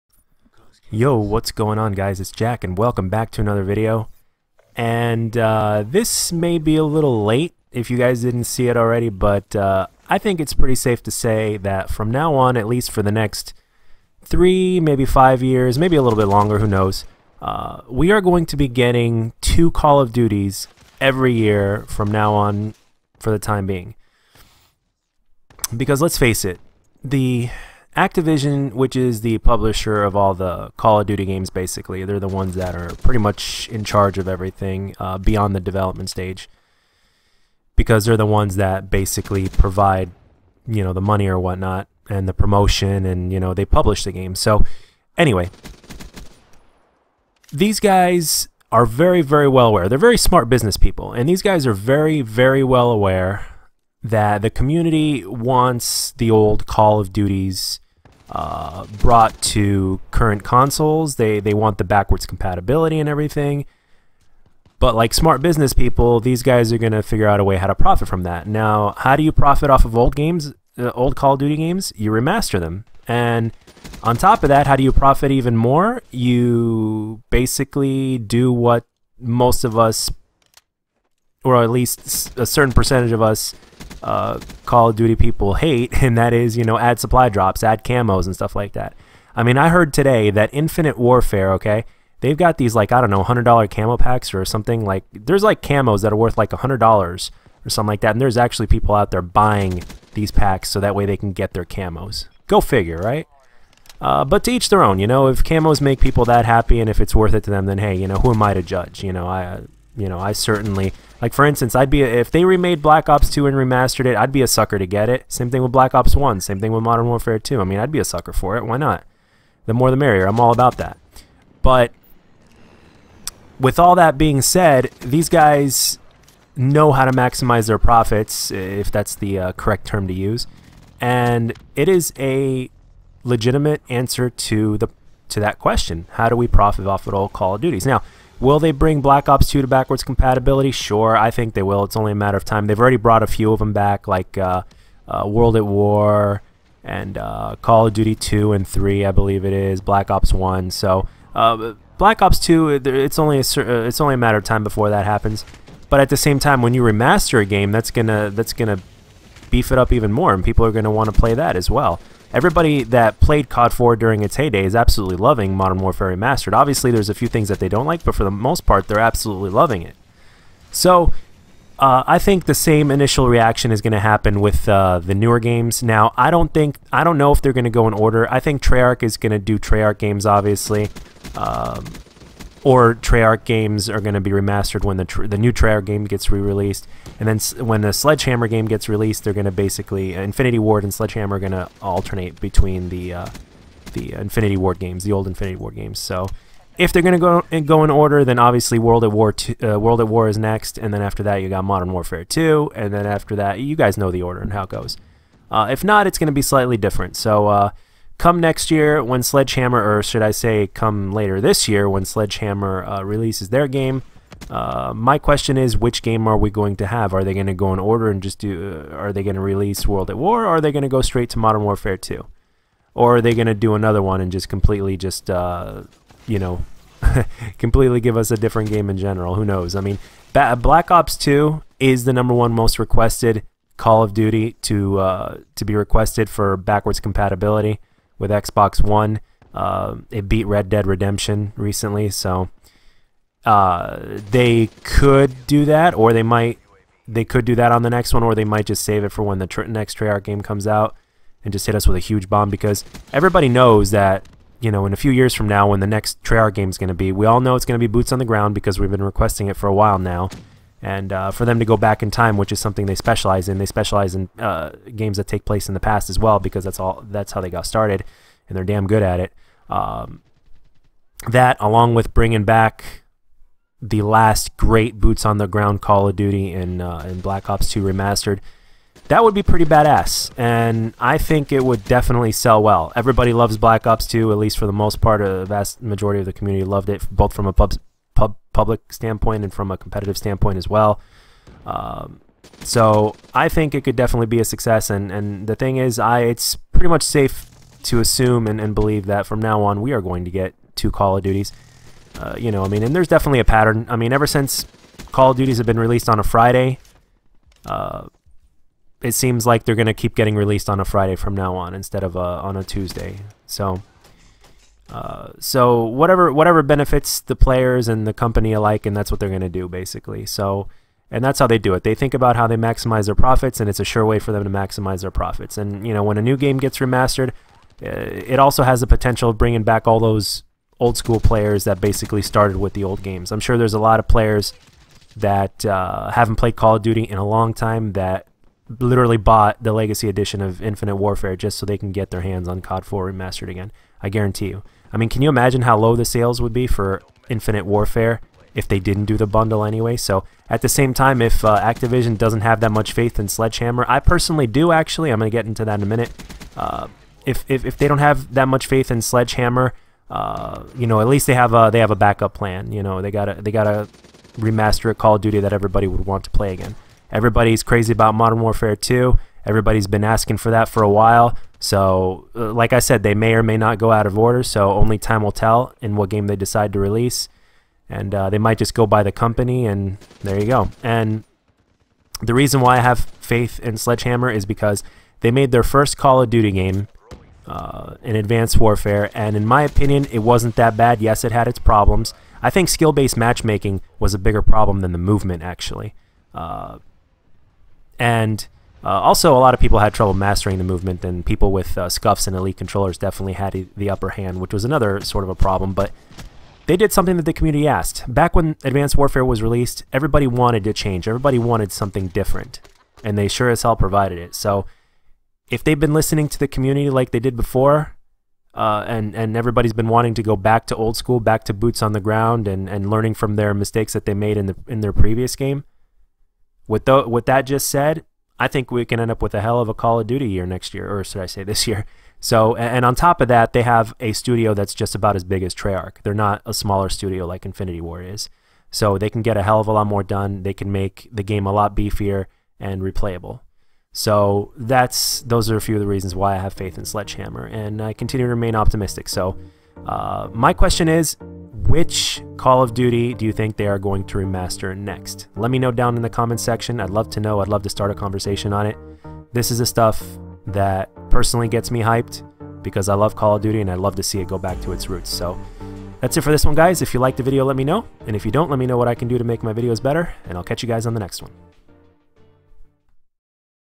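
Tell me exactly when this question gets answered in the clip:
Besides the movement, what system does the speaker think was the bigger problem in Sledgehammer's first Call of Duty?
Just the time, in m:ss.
6:32.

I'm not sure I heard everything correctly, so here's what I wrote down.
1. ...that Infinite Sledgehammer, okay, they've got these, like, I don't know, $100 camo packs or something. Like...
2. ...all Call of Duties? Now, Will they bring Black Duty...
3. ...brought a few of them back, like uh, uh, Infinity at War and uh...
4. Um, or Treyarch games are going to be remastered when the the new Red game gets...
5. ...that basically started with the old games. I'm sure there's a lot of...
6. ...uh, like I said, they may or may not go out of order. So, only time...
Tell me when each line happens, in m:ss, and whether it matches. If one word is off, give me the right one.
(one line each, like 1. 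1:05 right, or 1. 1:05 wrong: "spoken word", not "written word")
1. 1:30 wrong: "Warfare", not "Sledgehammer"
2. 2:17 wrong: "Ops", not "Duty"
3. 2:22 wrong: "World", not "Infinity"
4. 3:01 wrong: "Treyarch", not "Red"
5. 5:31 right
6. 6:12 right.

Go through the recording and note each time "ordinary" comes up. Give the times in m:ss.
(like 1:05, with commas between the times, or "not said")
not said.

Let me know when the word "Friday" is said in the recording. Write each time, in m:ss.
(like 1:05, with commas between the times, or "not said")
5:06, 5:10.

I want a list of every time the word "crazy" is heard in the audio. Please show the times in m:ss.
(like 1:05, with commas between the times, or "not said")
6:07.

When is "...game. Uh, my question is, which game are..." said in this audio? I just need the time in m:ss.
3:33.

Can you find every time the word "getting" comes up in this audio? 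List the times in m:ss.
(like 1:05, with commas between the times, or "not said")
0:18, 5:10.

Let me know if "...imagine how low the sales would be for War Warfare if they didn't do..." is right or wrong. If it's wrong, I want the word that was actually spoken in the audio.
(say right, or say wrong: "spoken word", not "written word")
wrong: "Infinite", not "War".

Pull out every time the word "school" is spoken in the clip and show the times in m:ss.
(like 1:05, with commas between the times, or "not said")
5:30, 7:00.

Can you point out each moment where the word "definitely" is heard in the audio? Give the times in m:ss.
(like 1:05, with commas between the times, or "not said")
4:41, 4:53, 5:03, 6:42.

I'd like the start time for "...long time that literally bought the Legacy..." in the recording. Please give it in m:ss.
5:37.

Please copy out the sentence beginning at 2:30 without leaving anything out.
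So uh, Black Ops 2, it's only a uh, it's only a matter of time before that happens.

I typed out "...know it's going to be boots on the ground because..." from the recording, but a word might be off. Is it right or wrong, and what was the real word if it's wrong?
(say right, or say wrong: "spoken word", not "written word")
right.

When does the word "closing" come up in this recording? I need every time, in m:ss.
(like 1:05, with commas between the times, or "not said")
not said.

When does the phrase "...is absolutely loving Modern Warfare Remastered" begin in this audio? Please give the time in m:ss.
2:44.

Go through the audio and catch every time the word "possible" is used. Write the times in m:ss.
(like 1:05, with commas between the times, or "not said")
not said.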